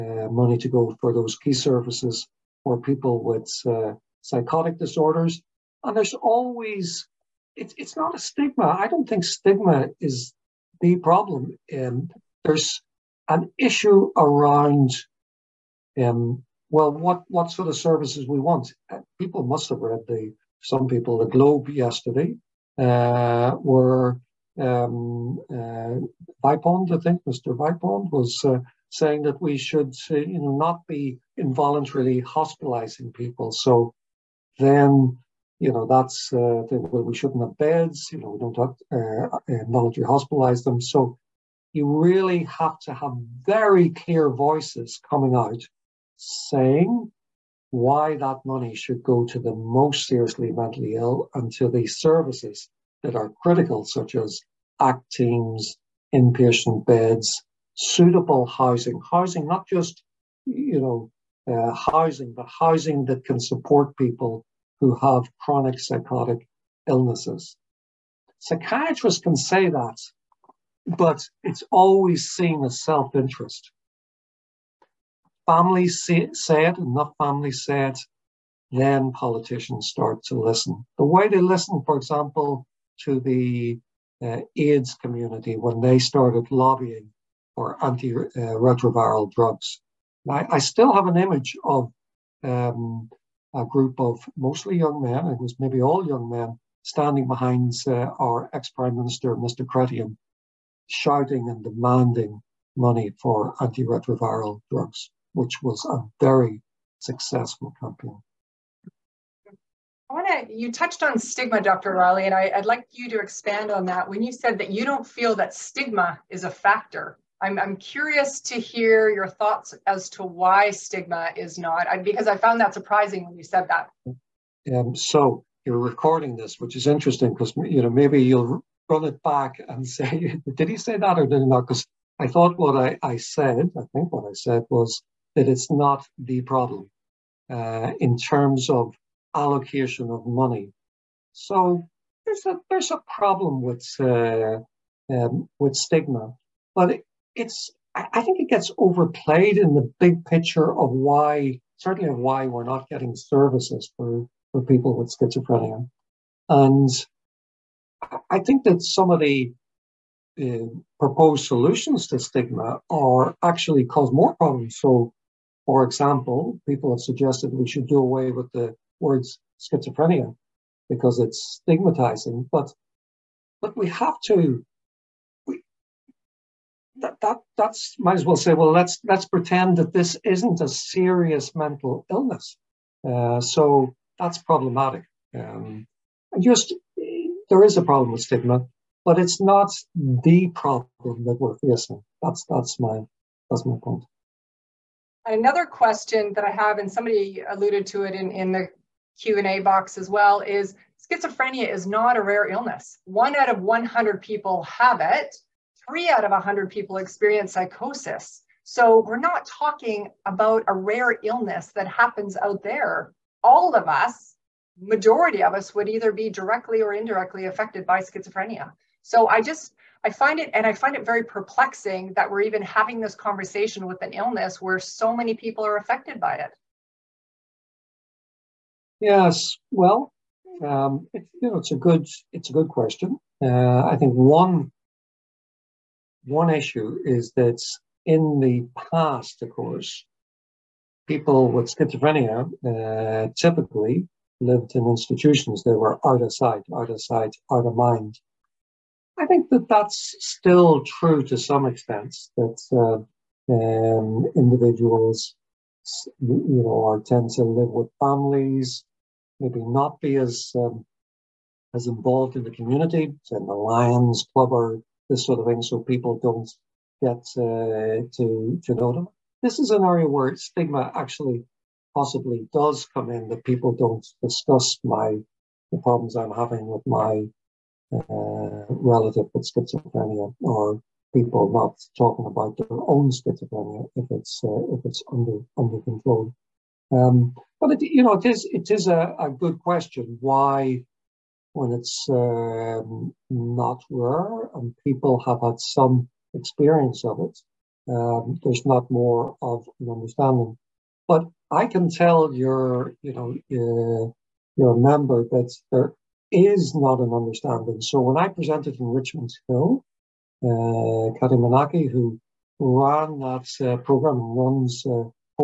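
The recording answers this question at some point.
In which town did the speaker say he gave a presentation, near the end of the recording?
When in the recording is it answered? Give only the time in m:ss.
5:08.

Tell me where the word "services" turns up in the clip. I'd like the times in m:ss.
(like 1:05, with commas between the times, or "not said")
0:01, 0:17, 0:51, 2:33.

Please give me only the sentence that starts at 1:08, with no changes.
Psychiatrists can say that but it's always seen as self-interest.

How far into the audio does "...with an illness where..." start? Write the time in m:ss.
3:43.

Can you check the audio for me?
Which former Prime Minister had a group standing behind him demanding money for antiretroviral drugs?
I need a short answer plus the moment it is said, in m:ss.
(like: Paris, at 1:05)
Chrétien, at 1:39.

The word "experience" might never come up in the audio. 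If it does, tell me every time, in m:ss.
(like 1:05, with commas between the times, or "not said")
3:26, 4:56.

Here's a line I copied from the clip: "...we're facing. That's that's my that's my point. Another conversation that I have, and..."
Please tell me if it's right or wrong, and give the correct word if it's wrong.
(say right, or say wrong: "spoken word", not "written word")
wrong: "question", not "conversation".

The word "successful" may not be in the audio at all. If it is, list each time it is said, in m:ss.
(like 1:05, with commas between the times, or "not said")
1:46.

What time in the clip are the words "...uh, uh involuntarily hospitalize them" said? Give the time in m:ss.
0:38.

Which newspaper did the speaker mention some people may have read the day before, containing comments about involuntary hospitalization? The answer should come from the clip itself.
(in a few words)
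The Globe.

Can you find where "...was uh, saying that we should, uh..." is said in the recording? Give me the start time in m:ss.
0:28.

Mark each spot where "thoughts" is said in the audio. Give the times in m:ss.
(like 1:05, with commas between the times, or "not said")
1:59, 2:12.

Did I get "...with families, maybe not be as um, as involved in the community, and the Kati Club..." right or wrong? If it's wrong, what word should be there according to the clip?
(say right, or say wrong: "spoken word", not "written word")
wrong: "Lions", not "Kati".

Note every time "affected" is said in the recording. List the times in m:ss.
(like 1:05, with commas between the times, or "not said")
3:37, 3:45.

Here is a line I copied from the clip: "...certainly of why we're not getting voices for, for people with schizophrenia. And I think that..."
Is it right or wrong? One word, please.
wrong.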